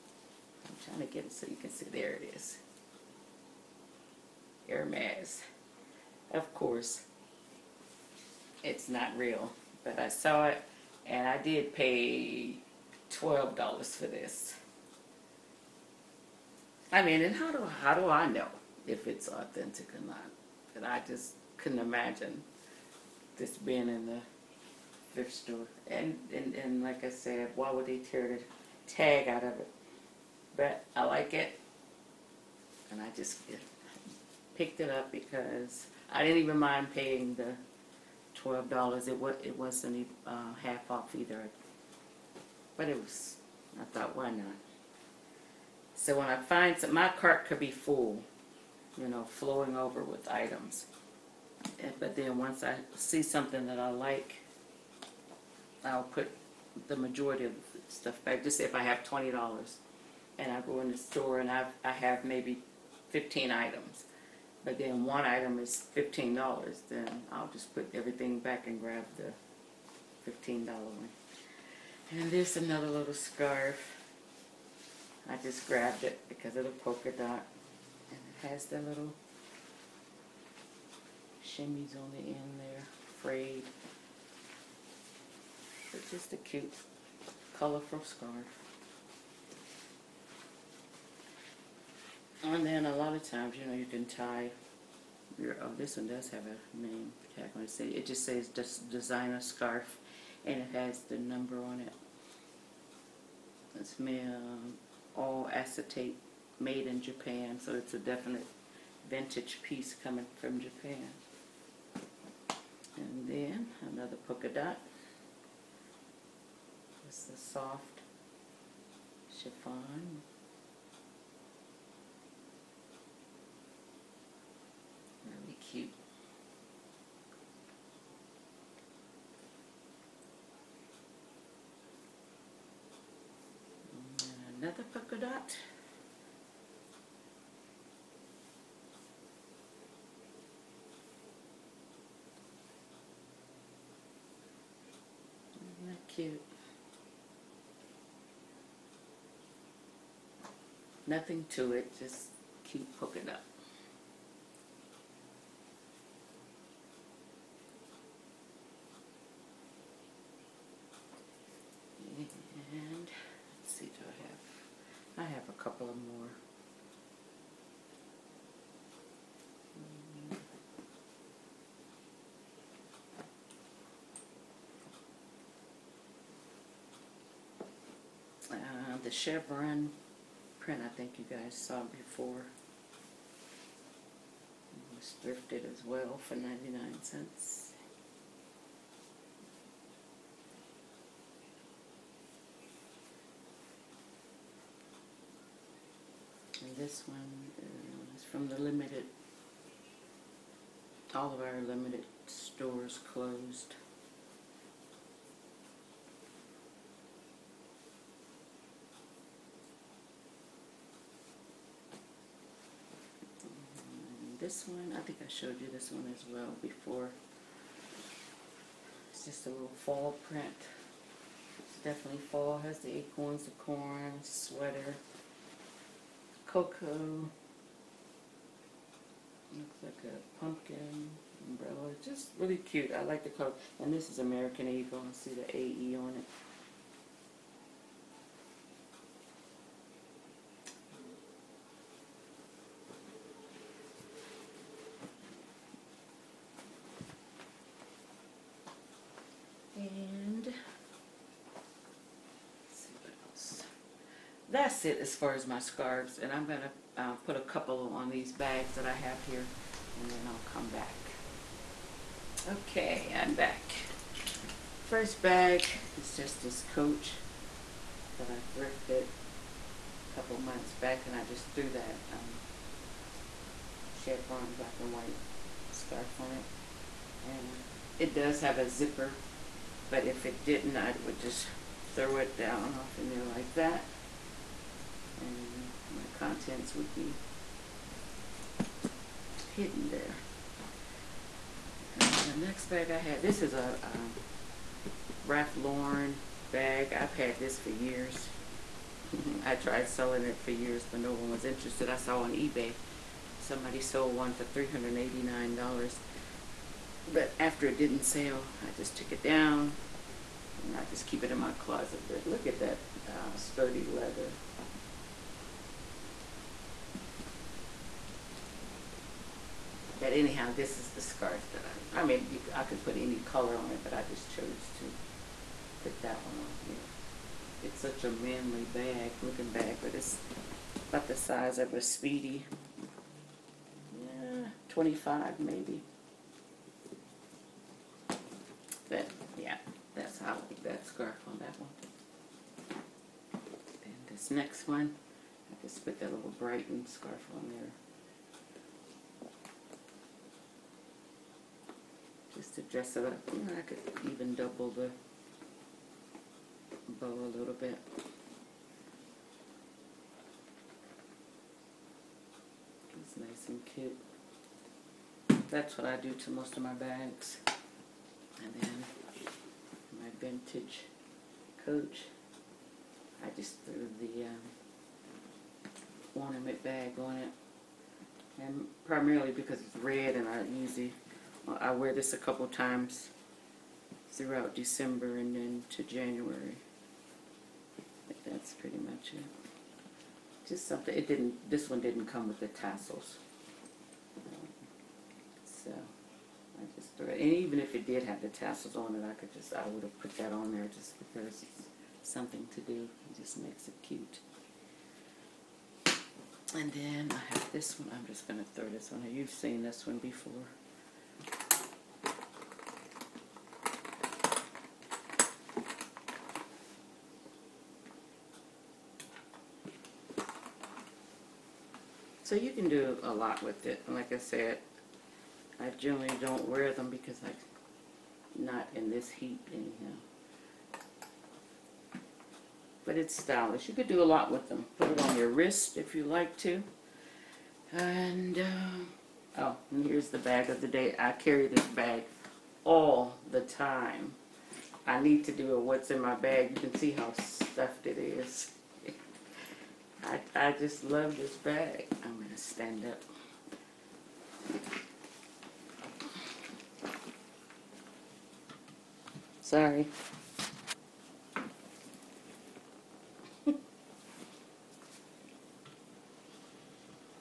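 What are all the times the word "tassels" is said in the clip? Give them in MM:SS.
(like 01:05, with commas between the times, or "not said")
06:32, 06:38.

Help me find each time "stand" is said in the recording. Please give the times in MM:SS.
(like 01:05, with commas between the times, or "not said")
07:32.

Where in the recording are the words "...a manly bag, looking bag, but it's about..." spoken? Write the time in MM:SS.
05:28.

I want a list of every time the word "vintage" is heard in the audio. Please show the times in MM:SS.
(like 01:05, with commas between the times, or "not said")
01:49, 06:10.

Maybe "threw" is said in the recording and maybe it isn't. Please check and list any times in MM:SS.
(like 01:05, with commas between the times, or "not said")
04:31, 06:13, 06:36.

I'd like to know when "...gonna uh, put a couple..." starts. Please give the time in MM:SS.
04:16.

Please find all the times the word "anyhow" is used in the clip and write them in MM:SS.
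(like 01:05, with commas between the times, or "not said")
05:20, 07:09.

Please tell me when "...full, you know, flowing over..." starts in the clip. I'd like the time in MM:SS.
00:47.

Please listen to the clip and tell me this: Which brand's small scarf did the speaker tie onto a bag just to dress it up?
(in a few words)
Brighton.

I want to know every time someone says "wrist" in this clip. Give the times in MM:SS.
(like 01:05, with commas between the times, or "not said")
07:15.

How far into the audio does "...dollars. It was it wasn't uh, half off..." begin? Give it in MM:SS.
00:38.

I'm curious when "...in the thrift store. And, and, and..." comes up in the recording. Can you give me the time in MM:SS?
00:23.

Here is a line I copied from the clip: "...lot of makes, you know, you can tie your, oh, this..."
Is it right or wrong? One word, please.
wrong.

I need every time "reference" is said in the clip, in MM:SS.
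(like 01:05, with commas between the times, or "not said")
not said.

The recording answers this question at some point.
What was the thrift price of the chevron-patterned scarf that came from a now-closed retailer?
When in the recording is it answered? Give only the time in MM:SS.
03:06.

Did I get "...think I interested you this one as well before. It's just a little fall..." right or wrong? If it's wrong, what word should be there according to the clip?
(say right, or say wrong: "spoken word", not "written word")
wrong: "showed", not "interested".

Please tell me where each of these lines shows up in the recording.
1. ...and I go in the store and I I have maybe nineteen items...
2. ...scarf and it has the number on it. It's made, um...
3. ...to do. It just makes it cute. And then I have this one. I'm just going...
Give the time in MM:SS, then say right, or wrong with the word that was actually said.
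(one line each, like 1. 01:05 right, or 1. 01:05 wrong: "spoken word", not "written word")
1. 01:00 wrong: "fifteen", not "nineteen"
2. 01:39 right
3. 06:42 right.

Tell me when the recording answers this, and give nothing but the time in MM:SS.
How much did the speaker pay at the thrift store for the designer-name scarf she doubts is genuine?
00:13.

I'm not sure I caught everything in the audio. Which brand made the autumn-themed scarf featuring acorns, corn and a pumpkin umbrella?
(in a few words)
American Eagle.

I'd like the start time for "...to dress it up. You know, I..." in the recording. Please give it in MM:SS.
05:52.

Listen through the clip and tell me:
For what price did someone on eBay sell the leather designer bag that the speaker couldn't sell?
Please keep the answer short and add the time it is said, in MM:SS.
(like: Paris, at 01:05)
$389, at 05:04.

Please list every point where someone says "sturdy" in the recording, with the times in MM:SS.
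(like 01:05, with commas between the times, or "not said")
05:13.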